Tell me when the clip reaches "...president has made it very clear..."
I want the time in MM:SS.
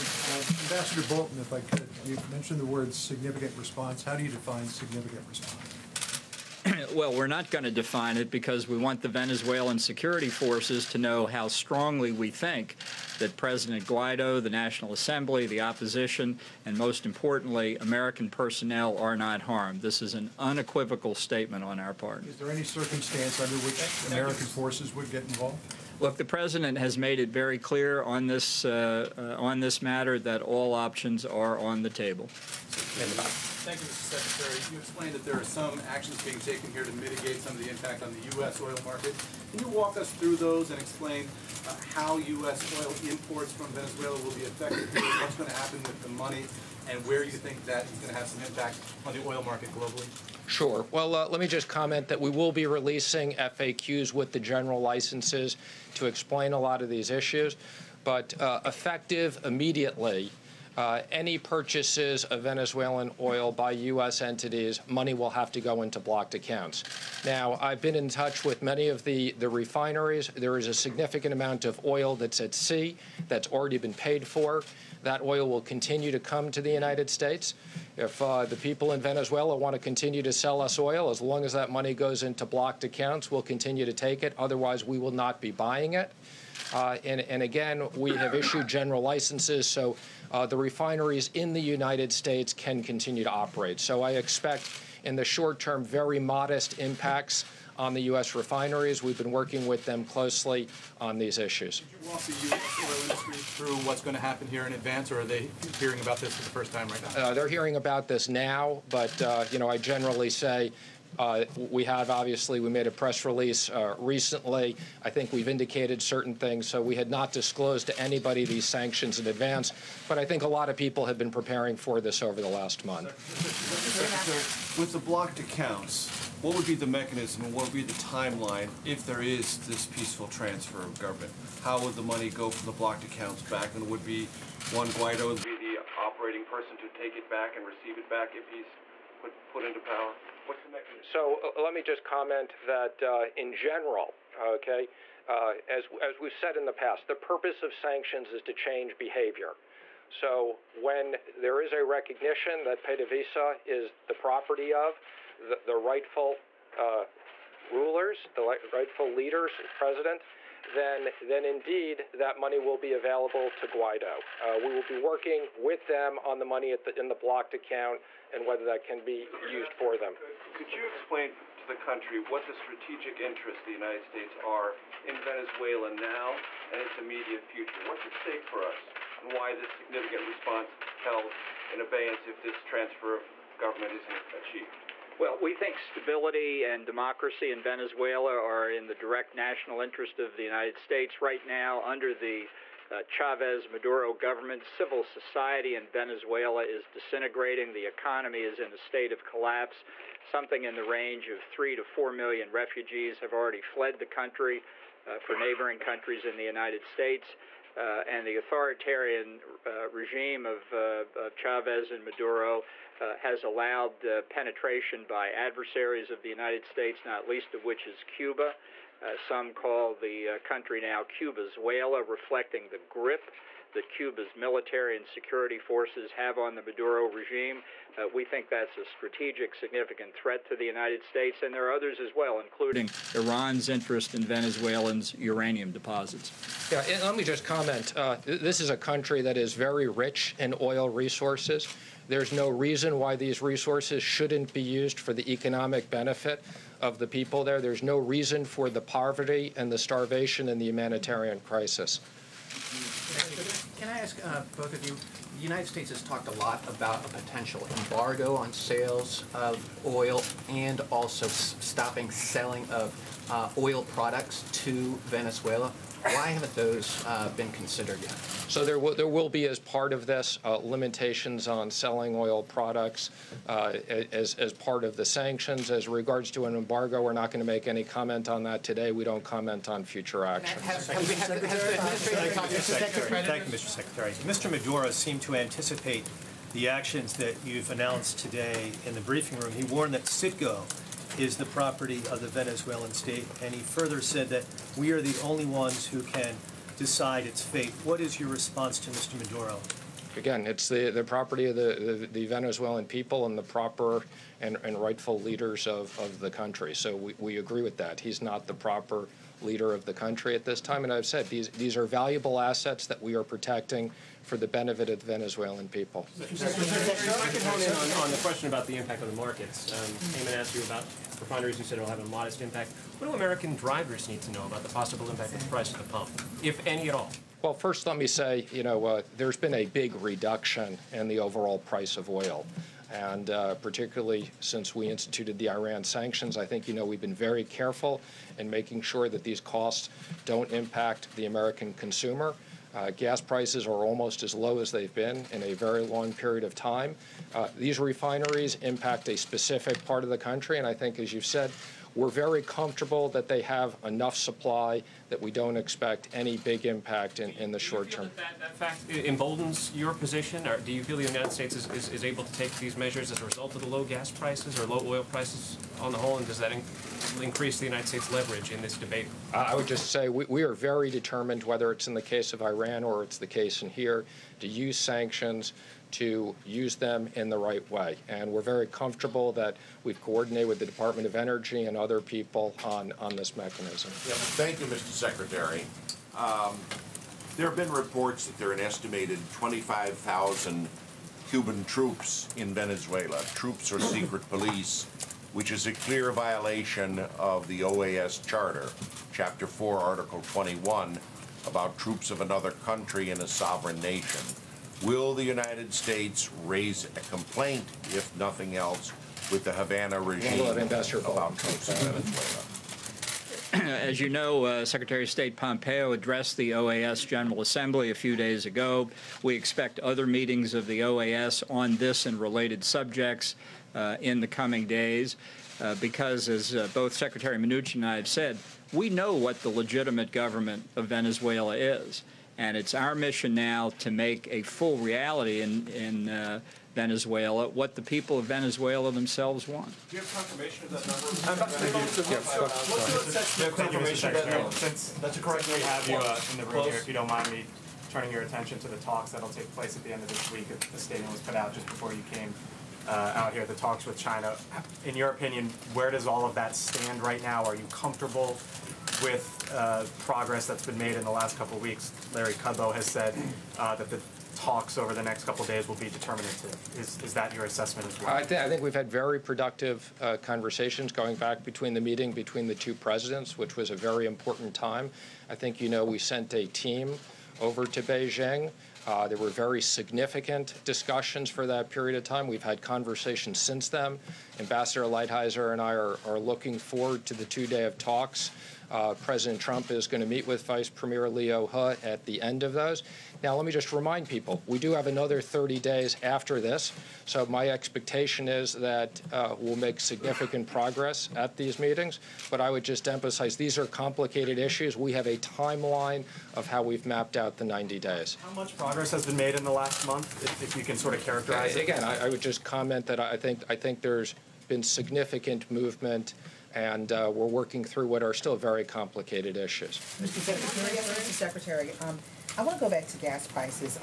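00:26.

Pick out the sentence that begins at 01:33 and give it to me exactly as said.
So I expect in the short term very modest impacts on the U.S.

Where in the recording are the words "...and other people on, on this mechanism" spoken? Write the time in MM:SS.
06:21.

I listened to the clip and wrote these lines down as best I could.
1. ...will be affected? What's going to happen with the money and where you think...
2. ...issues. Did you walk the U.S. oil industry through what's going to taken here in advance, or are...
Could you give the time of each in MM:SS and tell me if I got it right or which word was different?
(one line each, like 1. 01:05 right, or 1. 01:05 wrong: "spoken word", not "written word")
1. 00:44 right
2. 01:41 wrong: "happen", not "taken".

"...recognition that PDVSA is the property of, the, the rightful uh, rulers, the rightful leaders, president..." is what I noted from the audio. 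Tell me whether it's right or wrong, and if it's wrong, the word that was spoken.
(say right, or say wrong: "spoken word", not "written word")
right.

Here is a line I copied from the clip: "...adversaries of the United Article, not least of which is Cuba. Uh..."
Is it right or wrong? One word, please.
wrong.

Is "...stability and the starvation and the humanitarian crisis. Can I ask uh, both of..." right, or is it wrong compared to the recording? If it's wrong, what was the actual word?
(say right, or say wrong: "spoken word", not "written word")
wrong: "poverty", not "stability".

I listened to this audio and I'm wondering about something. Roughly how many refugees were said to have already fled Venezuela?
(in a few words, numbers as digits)
3 to 4 million.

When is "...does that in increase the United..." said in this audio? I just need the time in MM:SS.
06:06.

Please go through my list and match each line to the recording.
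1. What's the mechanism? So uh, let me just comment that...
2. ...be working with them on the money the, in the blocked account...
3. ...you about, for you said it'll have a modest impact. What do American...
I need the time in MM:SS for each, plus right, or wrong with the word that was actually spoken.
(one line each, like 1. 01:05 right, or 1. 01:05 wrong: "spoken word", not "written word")
1. 02:20 right
2. 02:44 right
3. 05:20 right.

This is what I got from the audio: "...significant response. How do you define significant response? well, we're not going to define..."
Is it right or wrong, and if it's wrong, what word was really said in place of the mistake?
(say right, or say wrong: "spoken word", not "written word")
right.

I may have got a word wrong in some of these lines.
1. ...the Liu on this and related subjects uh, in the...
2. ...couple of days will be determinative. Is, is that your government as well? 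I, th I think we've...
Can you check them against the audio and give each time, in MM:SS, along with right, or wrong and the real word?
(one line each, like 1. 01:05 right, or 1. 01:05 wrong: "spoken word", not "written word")
1. 07:00 wrong: "OAS", not "Liu"
2. 07:45 wrong: "assessment", not "government".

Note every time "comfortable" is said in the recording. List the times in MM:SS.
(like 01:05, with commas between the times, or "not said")
05:52, 06:18, 07:37.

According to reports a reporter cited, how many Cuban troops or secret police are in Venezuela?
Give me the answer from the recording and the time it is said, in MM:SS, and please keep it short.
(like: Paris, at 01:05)
25,000, at 06:29.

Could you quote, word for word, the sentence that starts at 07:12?
And it's our mission now to make a full reality in, in uh, Venezuela what the people of Venezuela themselves want.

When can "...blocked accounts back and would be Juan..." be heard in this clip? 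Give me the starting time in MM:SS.
02:12.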